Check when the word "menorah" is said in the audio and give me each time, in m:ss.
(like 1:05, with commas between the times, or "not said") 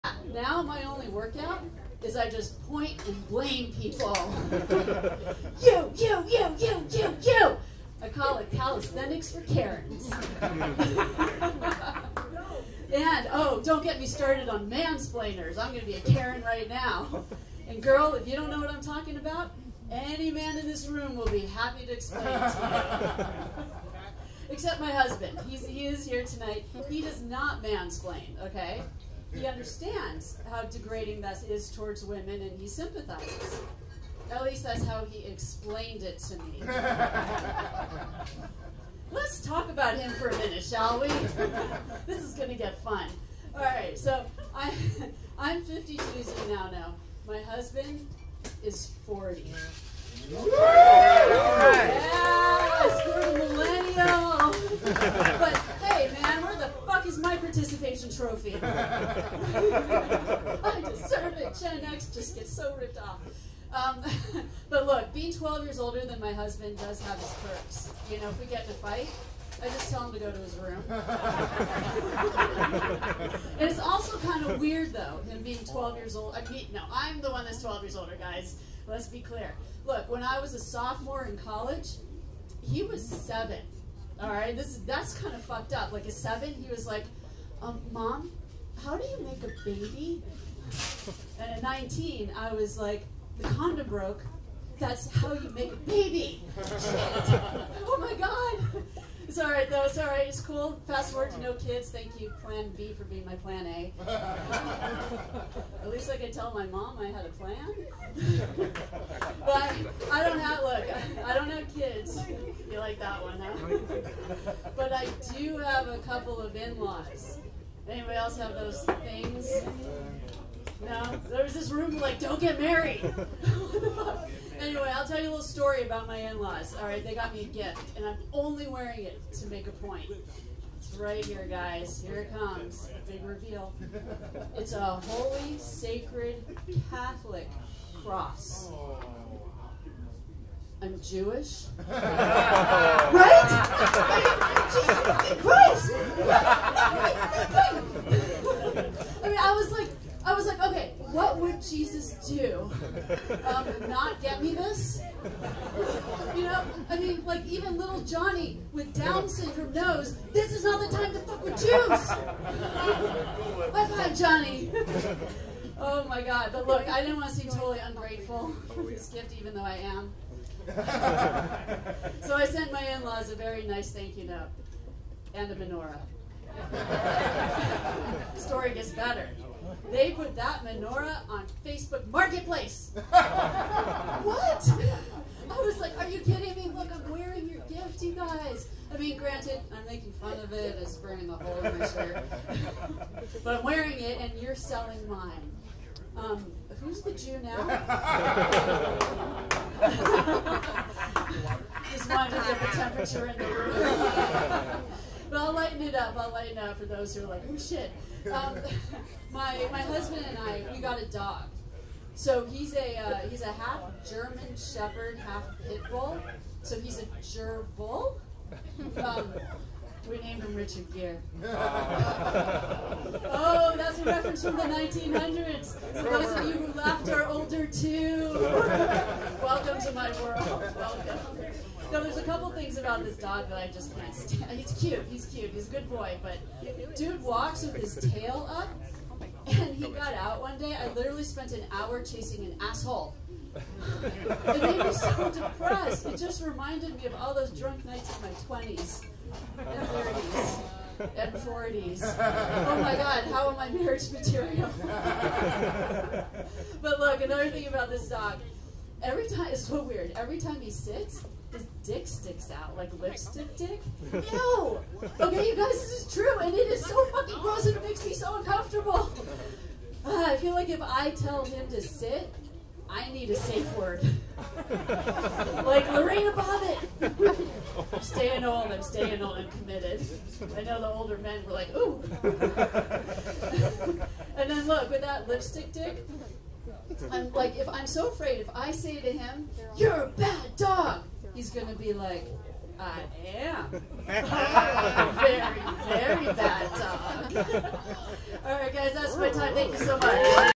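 2:55, 3:00.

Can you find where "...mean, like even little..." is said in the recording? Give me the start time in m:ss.
2:36.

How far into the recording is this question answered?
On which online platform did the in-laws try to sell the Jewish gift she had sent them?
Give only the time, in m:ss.
3:01.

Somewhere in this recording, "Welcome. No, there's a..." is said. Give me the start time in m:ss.
3:50.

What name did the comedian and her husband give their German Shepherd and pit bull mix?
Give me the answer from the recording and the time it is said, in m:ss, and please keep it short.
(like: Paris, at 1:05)
Richard Gere, at 3:40.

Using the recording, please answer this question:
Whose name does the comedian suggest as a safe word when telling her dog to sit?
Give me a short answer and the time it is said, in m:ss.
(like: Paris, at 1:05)
Lorena Bobbitt, at 4:35.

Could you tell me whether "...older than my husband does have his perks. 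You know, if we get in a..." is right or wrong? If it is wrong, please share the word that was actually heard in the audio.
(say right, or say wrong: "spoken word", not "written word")
right.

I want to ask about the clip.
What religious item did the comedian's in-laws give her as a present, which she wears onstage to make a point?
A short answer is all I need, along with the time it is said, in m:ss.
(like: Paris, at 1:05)
Catholic cross, at 2:16.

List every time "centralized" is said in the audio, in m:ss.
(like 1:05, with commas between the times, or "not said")
not said.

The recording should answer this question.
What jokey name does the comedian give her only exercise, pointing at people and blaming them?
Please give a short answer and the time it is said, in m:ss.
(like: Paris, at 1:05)
Calisthenics for Karens, at 0:08.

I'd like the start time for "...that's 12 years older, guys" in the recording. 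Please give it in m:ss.
1:17.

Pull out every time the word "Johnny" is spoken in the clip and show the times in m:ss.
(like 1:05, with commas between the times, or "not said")
2:38, 2:44.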